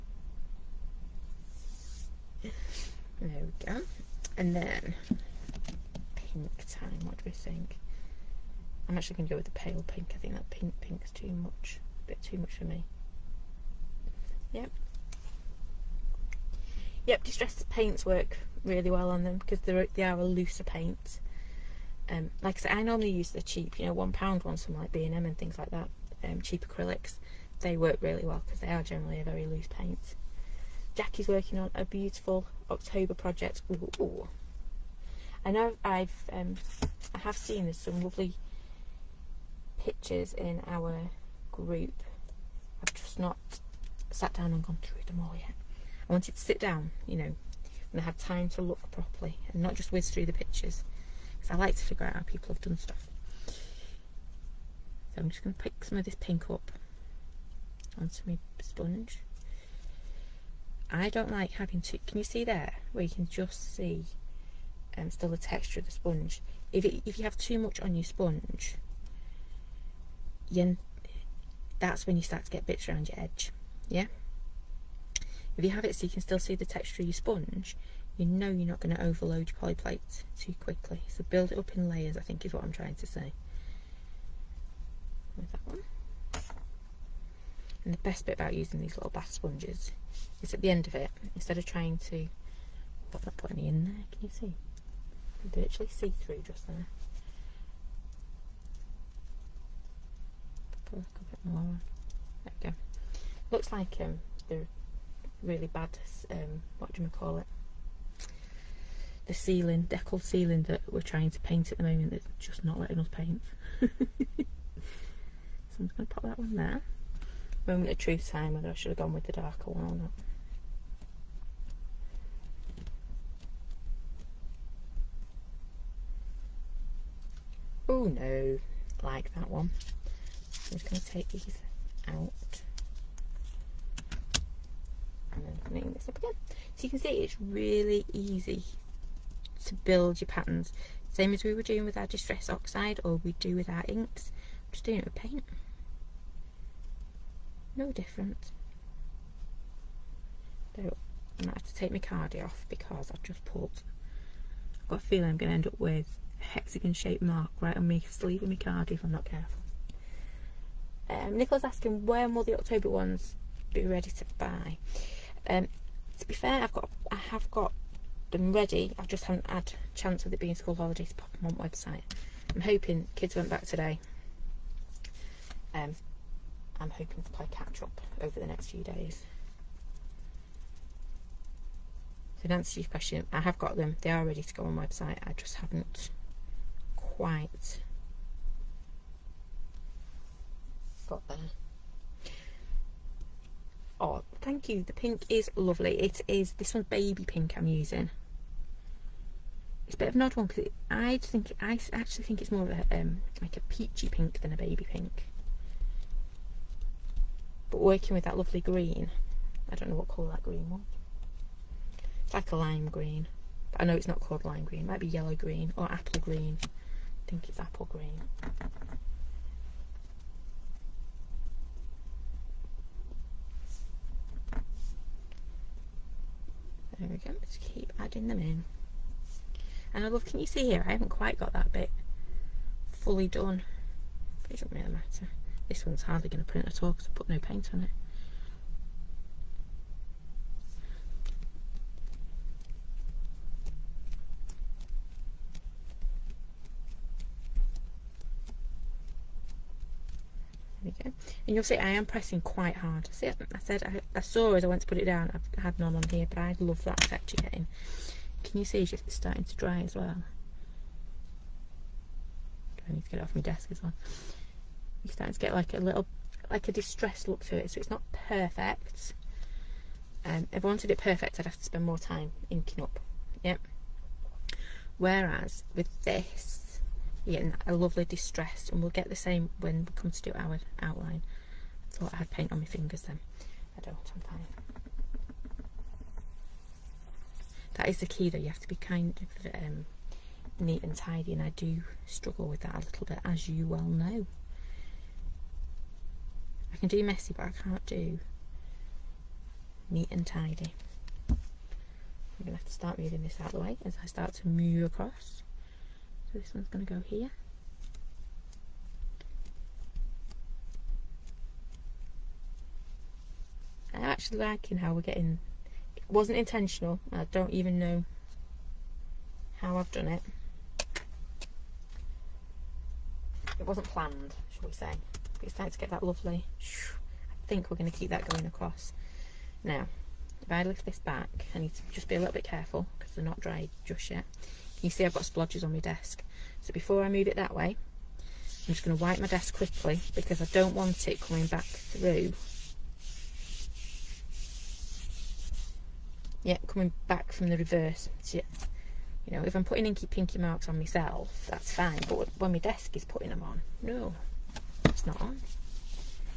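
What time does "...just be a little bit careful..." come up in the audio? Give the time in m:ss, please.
5:31.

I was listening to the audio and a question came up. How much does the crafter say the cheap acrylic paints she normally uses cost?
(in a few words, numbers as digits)
One pound.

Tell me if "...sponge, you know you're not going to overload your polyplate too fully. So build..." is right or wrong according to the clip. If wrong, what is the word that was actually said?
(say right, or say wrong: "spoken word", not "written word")
wrong: "quickly", not "fully".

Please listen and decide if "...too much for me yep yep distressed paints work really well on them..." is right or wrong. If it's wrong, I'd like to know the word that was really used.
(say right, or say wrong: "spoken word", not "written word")
right.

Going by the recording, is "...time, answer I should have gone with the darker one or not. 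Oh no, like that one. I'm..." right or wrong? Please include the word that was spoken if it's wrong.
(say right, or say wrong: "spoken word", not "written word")
wrong: "whether", not "answer".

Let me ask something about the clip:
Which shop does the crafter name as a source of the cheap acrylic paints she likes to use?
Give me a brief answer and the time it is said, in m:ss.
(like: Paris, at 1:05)
B and M, at 0:24.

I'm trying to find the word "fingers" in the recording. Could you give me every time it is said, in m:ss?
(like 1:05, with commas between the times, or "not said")
4:42.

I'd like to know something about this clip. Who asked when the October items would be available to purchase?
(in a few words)
Nicola.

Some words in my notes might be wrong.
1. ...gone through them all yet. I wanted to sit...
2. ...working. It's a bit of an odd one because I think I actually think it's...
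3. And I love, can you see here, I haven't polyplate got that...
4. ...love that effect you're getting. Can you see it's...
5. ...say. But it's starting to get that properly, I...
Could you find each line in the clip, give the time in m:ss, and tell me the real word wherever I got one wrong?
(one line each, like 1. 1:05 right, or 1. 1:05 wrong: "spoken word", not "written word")
1. 0:44 right
2. 3:17 wrong: "using", not "working"
3. 3:49 wrong: "quite", not "polyplate"
4. 4:16 right
5. 5:24 wrong: "lovely", not "properly".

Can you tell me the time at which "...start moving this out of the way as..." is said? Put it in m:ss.
5:02.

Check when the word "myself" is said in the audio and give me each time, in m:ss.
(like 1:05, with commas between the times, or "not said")
5:50.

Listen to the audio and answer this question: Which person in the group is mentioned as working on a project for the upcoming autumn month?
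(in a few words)
Jackie.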